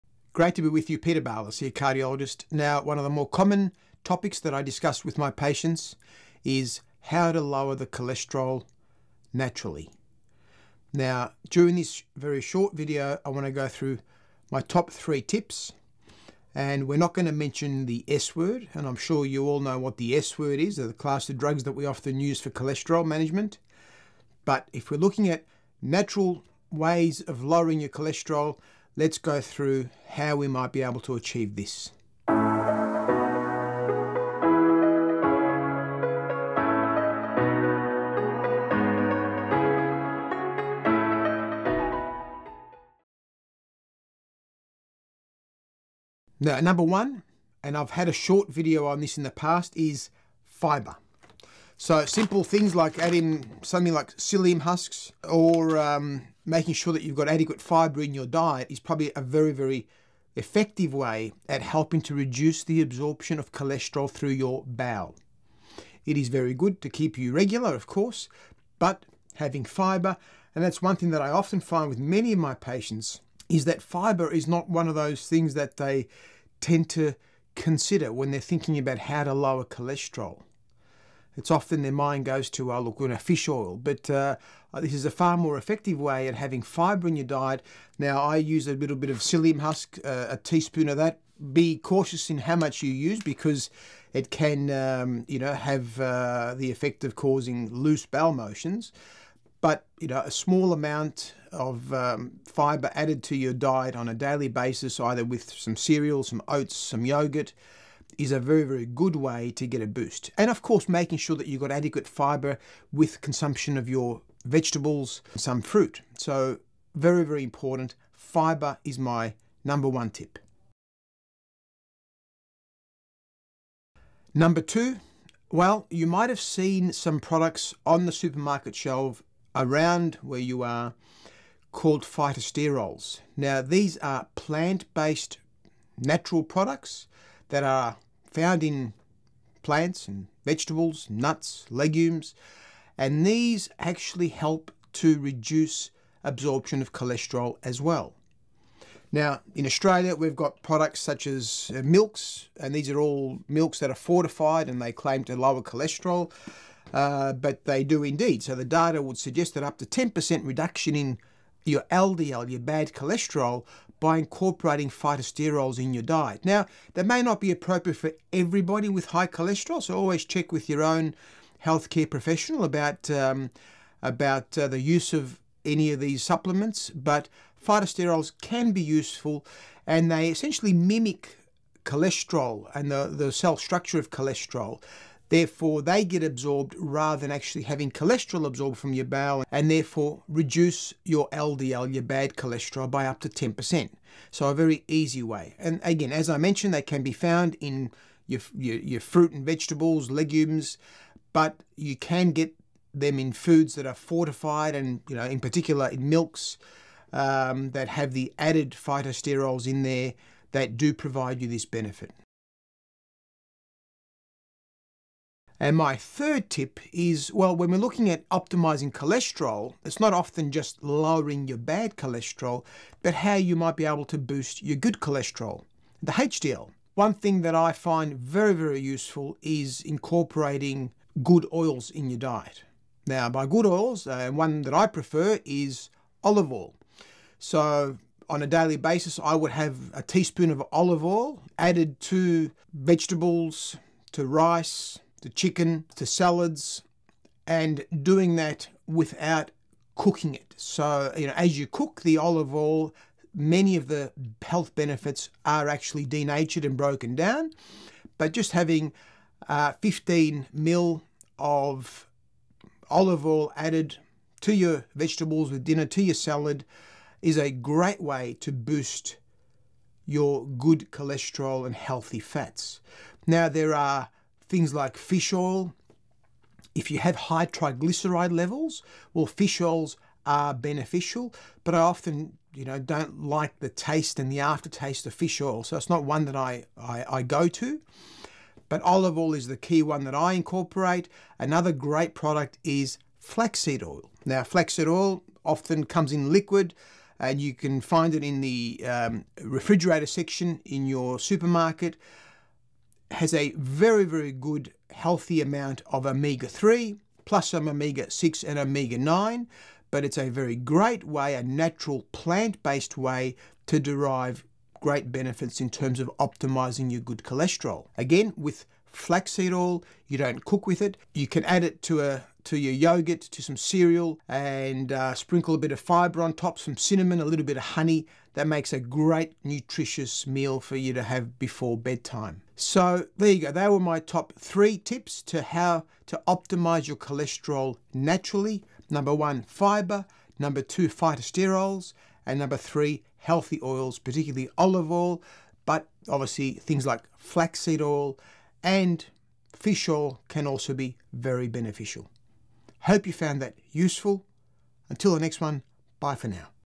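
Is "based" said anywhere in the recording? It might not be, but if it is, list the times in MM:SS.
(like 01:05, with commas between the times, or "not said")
02:14, 05:12.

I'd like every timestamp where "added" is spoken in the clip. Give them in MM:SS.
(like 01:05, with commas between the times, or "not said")
01:42, 03:28, 04:01, 04:23.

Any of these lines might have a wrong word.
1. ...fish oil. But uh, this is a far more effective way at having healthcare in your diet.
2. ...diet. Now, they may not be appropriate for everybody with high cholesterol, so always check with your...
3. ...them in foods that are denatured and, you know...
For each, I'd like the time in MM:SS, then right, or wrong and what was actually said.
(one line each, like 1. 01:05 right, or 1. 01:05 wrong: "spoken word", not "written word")
1. 01:23 wrong: "fibre", not "healthcare"
2. 02:46 right
3. 03:22 wrong: "fortified", not "denatured".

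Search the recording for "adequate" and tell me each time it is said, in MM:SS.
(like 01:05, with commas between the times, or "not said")
00:57, 01:51.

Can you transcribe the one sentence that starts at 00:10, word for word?
Now, during this very short video, I want to go through my top three tips.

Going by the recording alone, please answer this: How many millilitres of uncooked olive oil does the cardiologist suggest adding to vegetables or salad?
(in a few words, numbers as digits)
15 ml.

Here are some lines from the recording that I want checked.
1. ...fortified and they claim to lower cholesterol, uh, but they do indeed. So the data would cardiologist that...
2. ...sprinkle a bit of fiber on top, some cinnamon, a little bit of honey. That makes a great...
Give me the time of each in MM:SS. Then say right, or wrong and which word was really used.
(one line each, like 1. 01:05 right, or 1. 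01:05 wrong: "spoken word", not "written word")
1. 02:33 wrong: "suggest", not "cardiologist"
2. 05:25 right.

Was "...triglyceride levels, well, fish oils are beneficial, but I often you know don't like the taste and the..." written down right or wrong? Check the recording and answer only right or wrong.
right.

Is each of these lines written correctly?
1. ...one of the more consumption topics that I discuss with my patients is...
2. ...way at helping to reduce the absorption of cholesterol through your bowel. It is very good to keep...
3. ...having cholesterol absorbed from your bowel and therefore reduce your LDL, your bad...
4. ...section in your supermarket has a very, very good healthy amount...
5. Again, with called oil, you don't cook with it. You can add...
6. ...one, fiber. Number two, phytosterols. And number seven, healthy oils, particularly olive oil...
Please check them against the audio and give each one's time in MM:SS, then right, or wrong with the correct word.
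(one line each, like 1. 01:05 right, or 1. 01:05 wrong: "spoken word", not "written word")
1. 00:02 wrong: "common", not "consumption"
2. 01:00 right
3. 03:07 right
4. 05:00 right
5. 05:17 wrong: "flaxseed", not "called"
6. 05:39 wrong: "three", not "seven".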